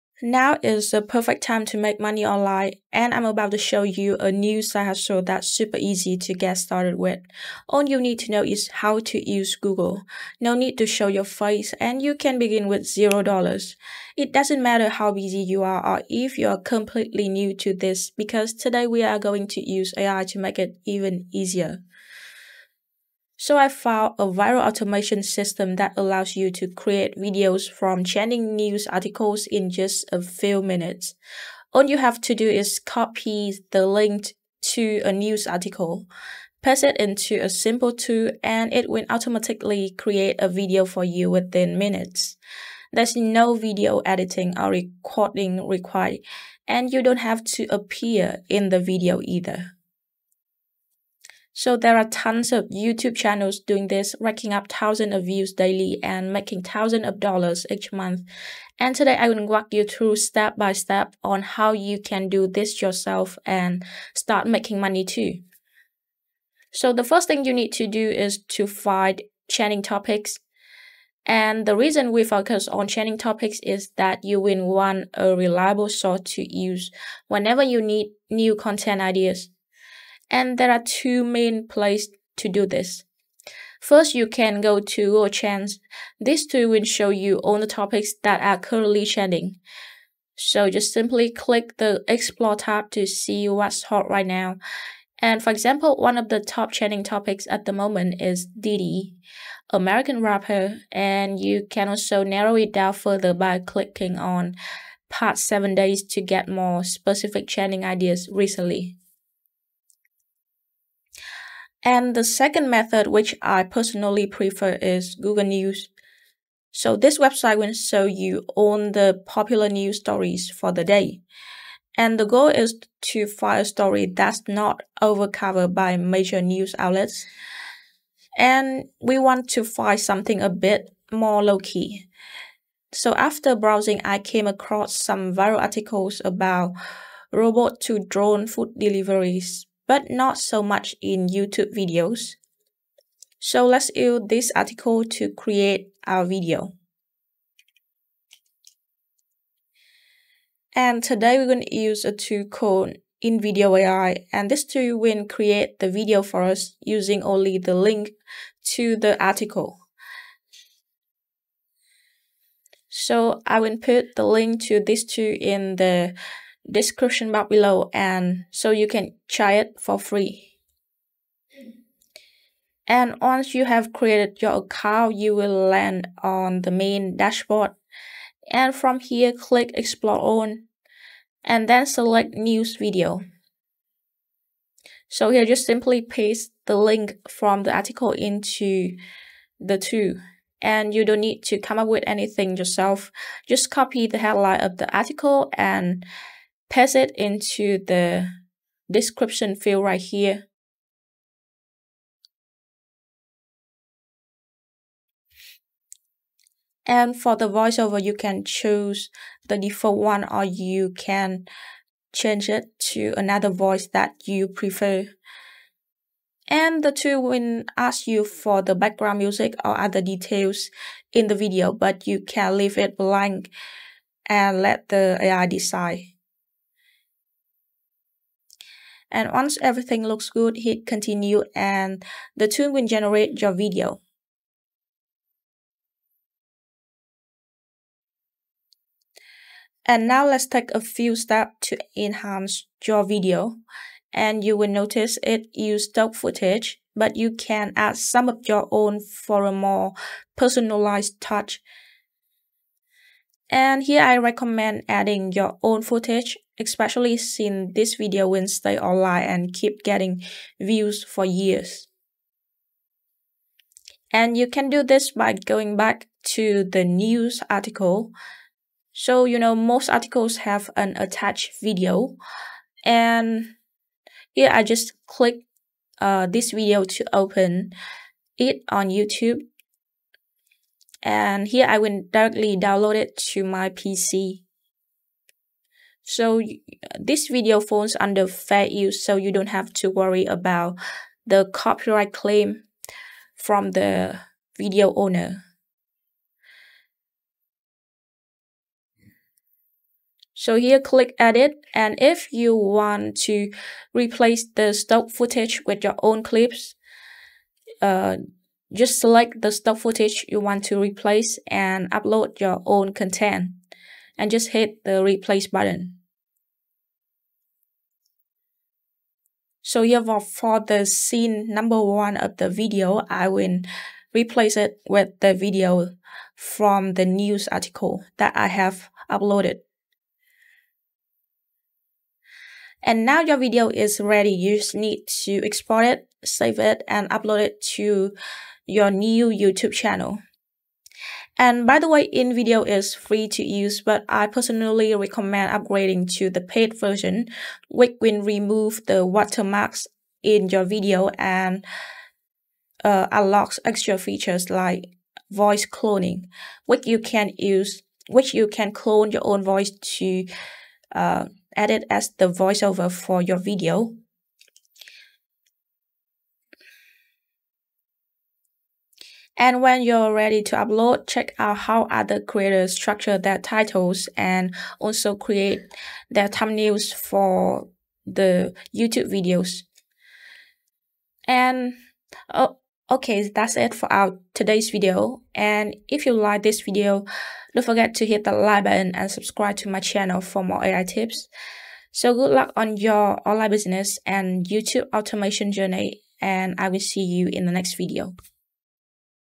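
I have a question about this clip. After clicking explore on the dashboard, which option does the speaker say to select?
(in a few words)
news video.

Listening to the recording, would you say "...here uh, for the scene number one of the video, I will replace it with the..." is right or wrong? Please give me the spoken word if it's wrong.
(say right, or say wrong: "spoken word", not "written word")
right.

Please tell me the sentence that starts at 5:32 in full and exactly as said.
And now your video is ready.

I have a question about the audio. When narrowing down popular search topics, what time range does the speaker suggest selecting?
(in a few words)
past 7 days.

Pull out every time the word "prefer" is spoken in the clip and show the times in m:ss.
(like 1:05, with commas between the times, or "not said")
1:54, 3:34.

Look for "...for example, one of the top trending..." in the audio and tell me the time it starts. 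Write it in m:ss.
1:35.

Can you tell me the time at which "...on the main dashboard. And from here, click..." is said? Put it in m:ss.
2:56.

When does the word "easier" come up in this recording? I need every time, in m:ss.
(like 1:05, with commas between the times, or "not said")
0:21.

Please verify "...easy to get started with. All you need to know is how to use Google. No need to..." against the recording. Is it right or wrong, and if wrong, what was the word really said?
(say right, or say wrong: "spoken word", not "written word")
right.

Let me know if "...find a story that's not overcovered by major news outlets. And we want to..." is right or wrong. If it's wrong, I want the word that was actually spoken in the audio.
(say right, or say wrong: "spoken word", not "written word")
right.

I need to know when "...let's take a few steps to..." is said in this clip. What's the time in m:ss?
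4:00.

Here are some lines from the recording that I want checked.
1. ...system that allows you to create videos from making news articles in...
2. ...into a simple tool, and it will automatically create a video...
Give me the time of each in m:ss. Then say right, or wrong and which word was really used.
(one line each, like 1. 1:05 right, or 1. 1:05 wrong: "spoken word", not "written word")
1. 0:25 wrong: "trending", not "making"
2. 0:36 right.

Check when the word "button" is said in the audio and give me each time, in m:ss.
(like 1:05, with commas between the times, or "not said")
5:15, 6:28.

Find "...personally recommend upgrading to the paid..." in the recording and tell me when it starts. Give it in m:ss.
5:44.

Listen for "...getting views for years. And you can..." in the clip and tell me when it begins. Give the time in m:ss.
4:19.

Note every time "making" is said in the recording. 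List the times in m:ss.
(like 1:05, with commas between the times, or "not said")
0:56, 1:04.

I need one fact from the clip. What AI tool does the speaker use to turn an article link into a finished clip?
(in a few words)
InVideo AI.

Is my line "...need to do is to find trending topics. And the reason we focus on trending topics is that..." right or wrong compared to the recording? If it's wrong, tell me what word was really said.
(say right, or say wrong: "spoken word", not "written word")
right.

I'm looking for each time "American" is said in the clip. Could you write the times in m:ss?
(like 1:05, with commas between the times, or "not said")
1:39.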